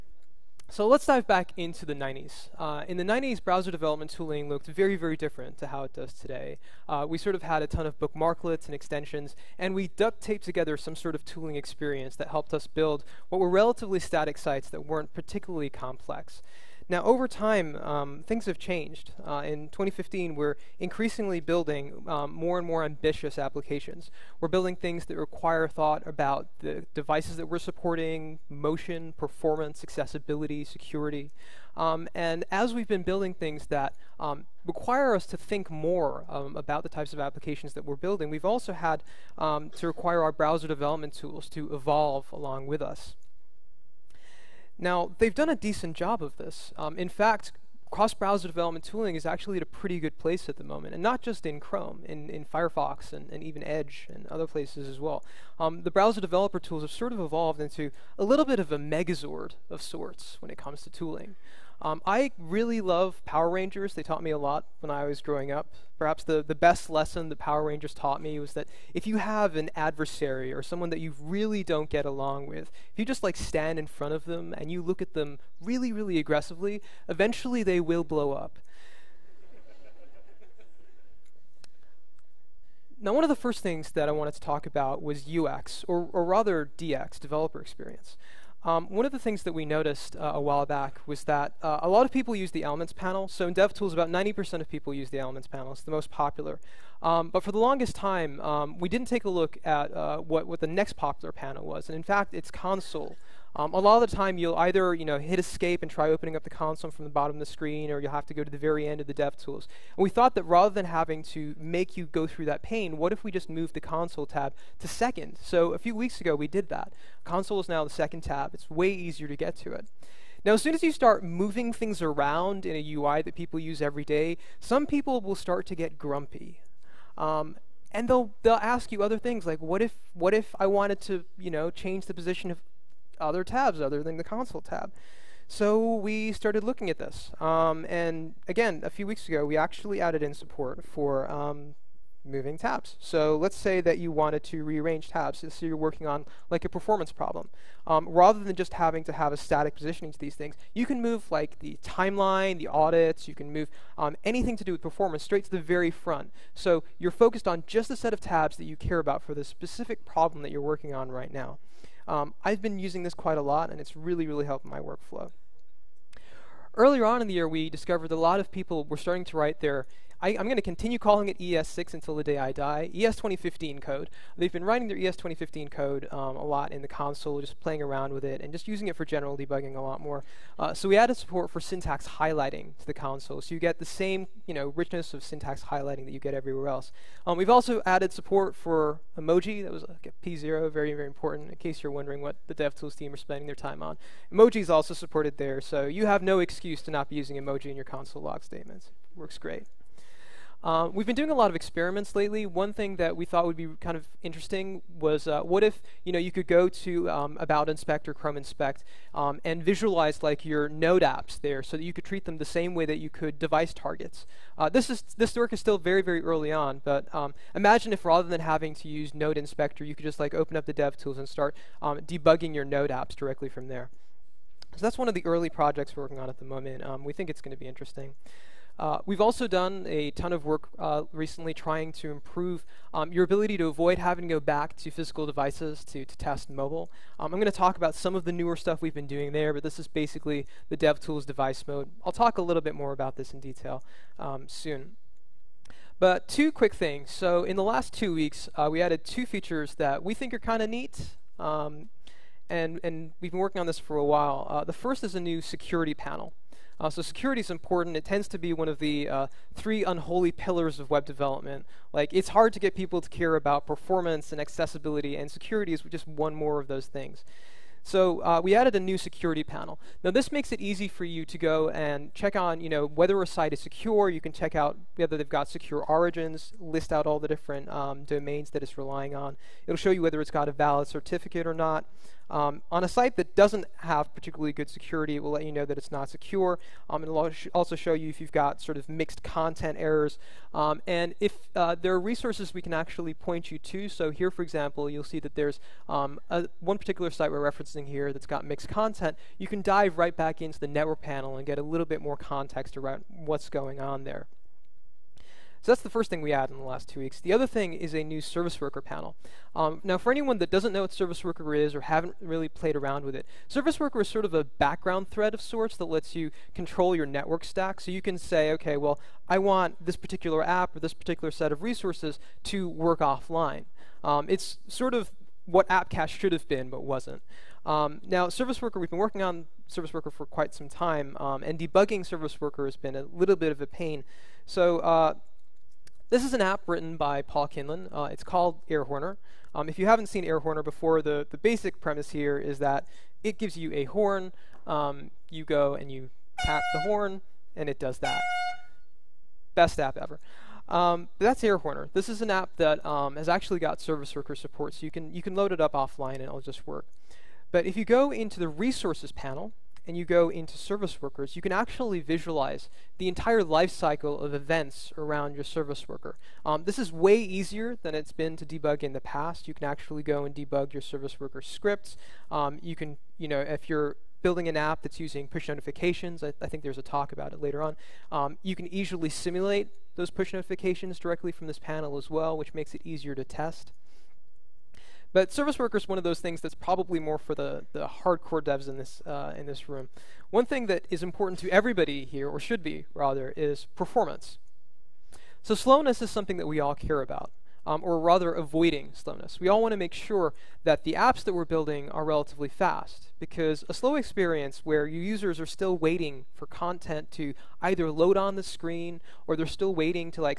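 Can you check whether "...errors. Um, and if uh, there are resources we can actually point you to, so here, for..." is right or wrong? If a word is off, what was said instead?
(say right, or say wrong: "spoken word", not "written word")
right.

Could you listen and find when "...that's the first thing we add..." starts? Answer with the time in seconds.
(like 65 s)
305 s.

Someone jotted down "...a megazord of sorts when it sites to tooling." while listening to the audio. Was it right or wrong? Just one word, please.
wrong.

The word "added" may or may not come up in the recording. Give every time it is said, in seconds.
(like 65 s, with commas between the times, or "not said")
140 s, 180 s, 187 s, 248 s, 268 s.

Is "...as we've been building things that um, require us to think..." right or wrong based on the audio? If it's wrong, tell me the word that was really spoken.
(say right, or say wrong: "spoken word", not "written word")
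right.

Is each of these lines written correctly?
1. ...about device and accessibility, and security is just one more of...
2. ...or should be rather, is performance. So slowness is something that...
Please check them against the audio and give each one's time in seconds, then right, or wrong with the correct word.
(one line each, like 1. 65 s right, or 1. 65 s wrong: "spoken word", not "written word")
1. 263 s wrong: "performance", not "device"
2. 392 s right.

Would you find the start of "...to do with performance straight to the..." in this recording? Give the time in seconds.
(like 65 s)
154 s.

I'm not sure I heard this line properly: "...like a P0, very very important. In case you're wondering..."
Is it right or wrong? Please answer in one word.
right.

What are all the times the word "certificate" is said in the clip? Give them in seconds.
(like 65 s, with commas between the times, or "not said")
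280 s.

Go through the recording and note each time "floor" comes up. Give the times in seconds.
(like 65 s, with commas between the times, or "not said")
not said.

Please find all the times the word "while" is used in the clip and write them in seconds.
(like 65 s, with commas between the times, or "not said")
90 s, 254 s.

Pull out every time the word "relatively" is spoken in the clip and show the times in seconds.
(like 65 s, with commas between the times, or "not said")
13 s, 402 s.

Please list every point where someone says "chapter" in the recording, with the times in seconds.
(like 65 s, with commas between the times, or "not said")
not said.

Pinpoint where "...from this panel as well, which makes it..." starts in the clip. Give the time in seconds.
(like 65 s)
381 s.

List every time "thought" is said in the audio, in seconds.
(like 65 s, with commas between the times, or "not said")
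25 s, 110 s, 203 s.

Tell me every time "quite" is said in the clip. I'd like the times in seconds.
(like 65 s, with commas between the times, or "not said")
163 s, 330 s.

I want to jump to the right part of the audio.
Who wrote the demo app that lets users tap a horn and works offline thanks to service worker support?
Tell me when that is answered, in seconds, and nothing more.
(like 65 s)
337 s.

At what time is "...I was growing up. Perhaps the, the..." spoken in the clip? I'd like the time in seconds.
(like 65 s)
64 s.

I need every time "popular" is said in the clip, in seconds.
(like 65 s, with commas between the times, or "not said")
96 s, 100 s.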